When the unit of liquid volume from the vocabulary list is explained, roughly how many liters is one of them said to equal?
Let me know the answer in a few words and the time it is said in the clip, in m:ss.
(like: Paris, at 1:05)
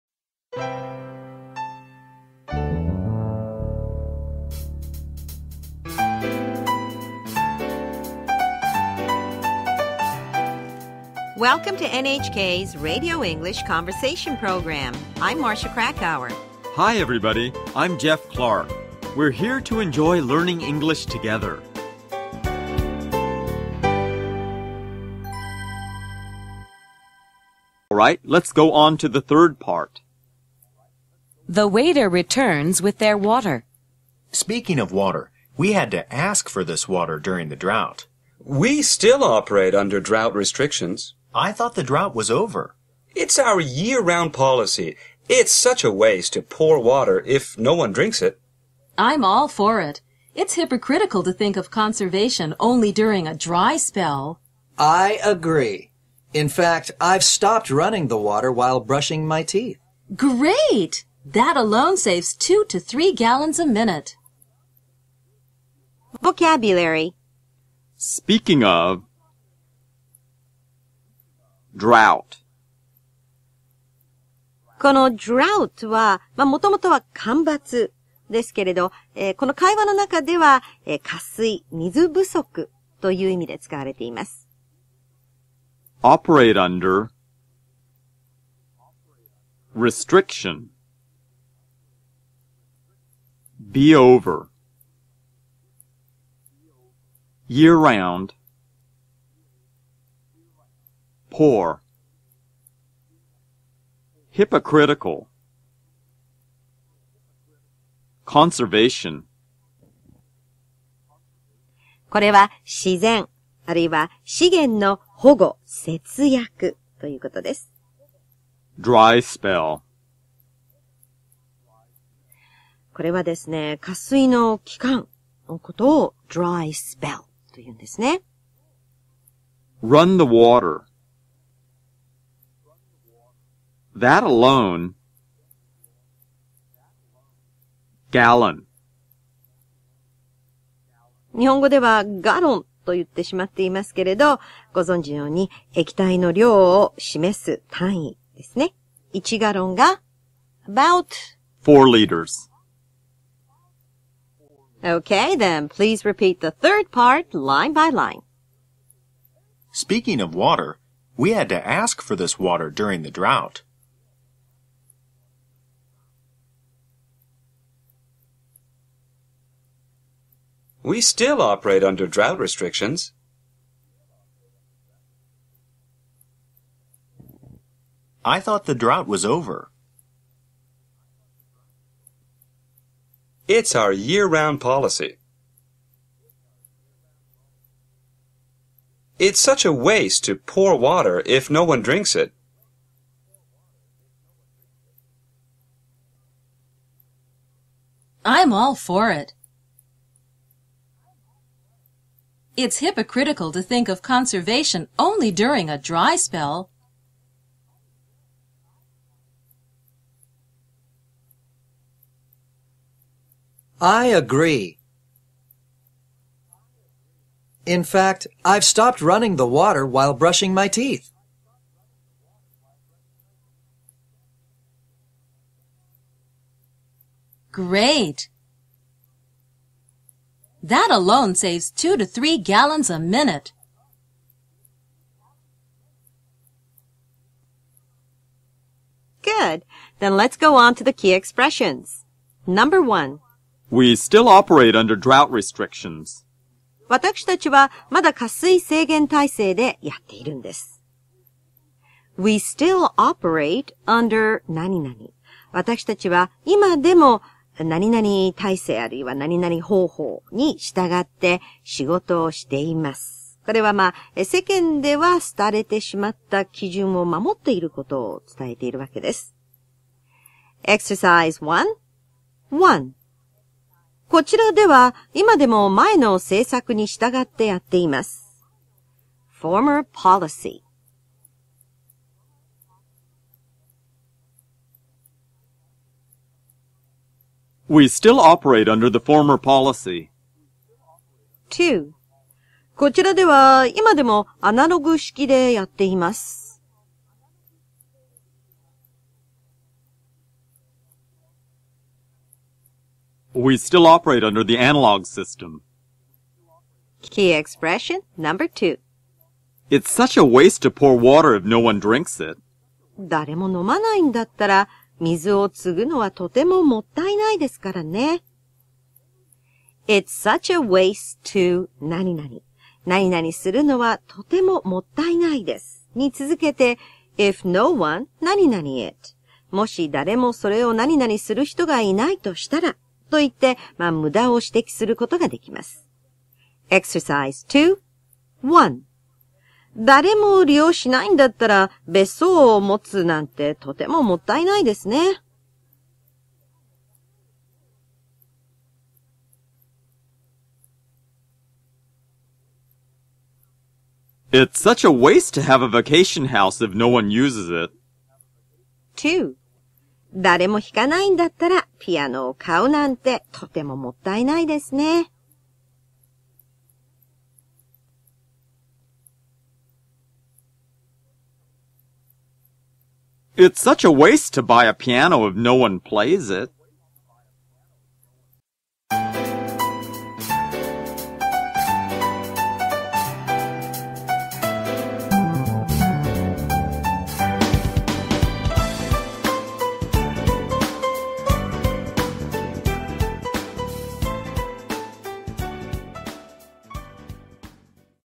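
about 4 liters, at 2:30.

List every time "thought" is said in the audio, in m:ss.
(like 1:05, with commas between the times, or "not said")
0:41, 2:58.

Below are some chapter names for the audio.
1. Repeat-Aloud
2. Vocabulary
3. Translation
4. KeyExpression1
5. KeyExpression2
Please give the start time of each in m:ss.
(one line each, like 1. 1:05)
1. 2:35
2. 1:06
3. 0:28
4. 3:59
5. 5:07.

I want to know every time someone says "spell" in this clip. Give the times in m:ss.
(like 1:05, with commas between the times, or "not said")
0:53, 1:59, 2:06, 3:26.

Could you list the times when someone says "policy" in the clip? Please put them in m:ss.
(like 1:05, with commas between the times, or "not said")
0:44, 3:04, 4:39, 4:49.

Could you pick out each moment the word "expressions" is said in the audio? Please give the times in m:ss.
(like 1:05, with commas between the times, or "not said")
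4:01, 5:07.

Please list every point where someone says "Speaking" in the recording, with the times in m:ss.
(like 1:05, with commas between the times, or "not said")
0:34, 1:07, 2:39.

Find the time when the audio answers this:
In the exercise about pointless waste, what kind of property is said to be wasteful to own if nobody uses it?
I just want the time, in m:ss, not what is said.
5:55.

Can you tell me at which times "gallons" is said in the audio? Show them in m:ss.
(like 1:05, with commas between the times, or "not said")
1:03, 2:18, 3:52.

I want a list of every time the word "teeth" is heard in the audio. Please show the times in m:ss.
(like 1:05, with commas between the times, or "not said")
0:59, 3:40.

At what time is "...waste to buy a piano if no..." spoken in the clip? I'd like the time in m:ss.
6:13.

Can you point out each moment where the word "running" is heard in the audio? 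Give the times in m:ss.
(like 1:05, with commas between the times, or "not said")
0:57, 3:39.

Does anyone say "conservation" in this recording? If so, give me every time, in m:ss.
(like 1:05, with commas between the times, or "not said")
0:51, 1:48, 3:24.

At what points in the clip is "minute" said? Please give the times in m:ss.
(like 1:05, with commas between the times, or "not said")
1:03, 3:52.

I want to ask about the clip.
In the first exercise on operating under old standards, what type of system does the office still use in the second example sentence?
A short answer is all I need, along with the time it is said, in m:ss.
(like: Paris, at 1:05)
analog system, at 5:04.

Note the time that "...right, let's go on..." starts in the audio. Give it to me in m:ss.
0:27.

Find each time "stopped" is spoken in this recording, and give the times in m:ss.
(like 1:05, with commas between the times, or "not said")
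0:57, 3:38.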